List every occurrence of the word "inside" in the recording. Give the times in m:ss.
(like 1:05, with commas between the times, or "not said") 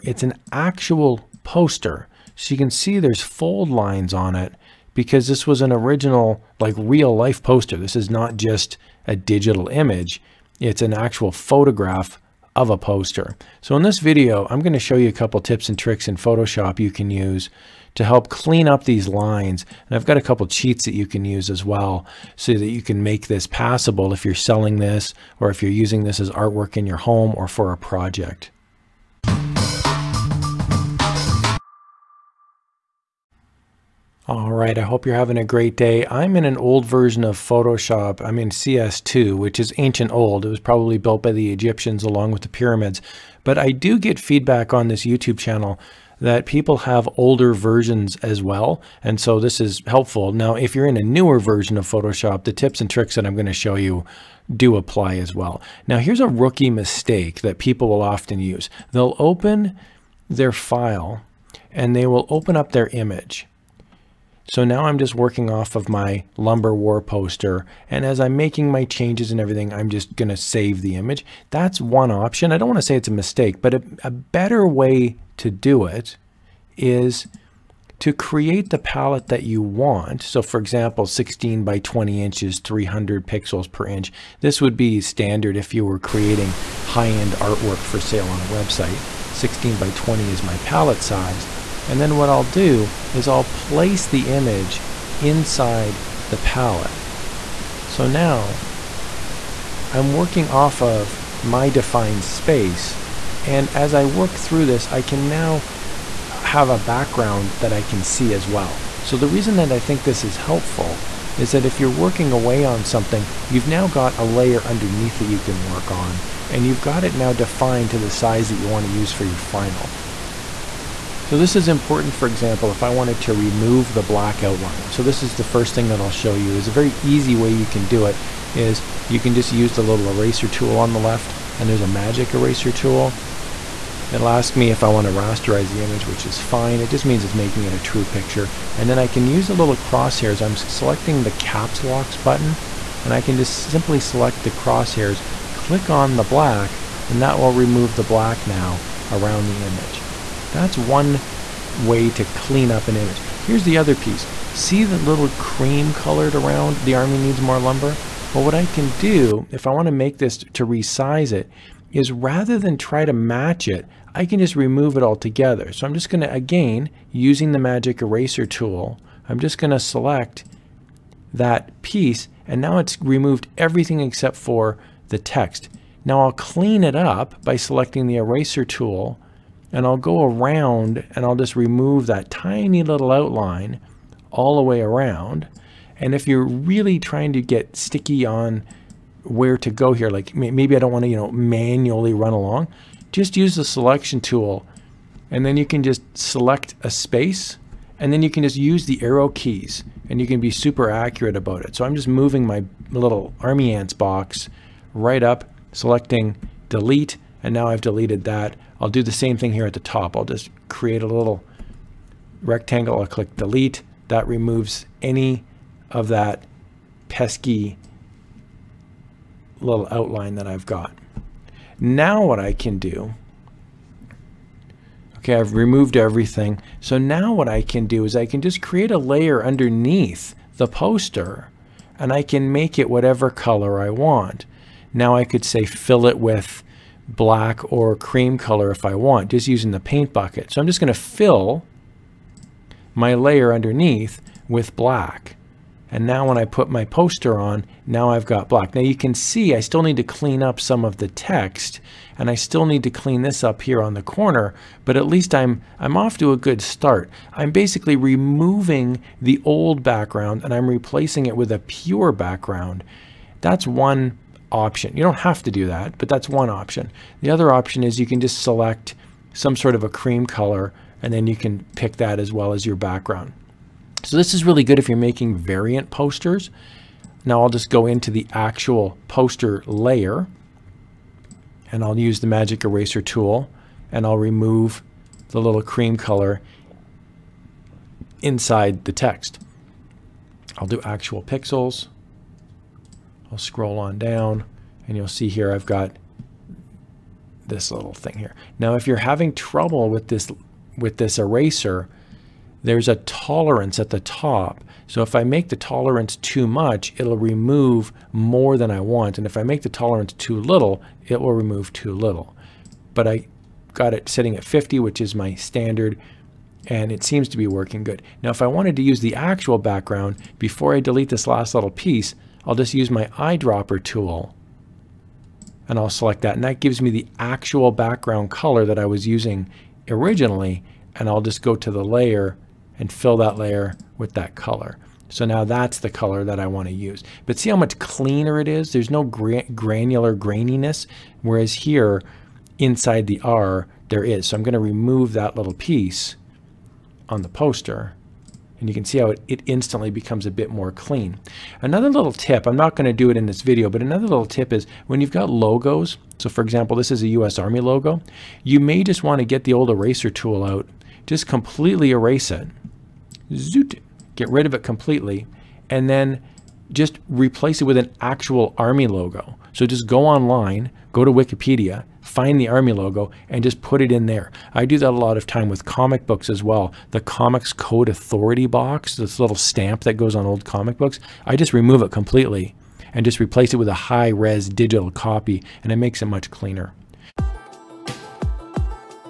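1:35, 4:48, 5:42.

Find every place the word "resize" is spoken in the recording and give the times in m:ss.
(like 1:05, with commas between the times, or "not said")
2:40.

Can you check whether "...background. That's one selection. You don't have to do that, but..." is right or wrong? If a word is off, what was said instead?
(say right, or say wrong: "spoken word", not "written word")
wrong: "option", not "selection".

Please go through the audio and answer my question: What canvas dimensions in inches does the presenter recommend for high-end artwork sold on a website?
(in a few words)
16 by 20 inches.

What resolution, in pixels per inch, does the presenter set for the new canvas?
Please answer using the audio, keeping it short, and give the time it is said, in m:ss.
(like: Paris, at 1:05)
300, at 1:22.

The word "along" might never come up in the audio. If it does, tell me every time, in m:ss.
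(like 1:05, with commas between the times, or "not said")
0:42, 3:12.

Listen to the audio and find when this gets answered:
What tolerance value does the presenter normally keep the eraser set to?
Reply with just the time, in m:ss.
5:14.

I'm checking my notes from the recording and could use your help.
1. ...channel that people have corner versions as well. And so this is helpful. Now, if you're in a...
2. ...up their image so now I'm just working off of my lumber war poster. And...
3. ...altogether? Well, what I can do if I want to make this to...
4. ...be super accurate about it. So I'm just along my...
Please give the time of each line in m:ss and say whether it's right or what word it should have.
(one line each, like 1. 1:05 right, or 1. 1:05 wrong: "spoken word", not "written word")
1. 0:45 wrong: "older", not "corner"
2. 1:02 right
3. 2:37 wrong: "lumber", not "altogether"
4. 3:20 wrong: "moving", not "along".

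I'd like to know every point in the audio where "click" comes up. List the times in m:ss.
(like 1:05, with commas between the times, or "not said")
2:25, 3:33.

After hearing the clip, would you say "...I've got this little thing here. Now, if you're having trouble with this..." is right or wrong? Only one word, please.
right.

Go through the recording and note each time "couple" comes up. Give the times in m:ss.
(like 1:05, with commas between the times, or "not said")
0:15, 0:20.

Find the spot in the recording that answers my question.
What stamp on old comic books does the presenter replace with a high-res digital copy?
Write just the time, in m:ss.
6:17.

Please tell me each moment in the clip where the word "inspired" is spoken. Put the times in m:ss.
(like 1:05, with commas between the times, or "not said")
not said.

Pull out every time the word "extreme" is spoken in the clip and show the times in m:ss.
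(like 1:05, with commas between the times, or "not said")
not said.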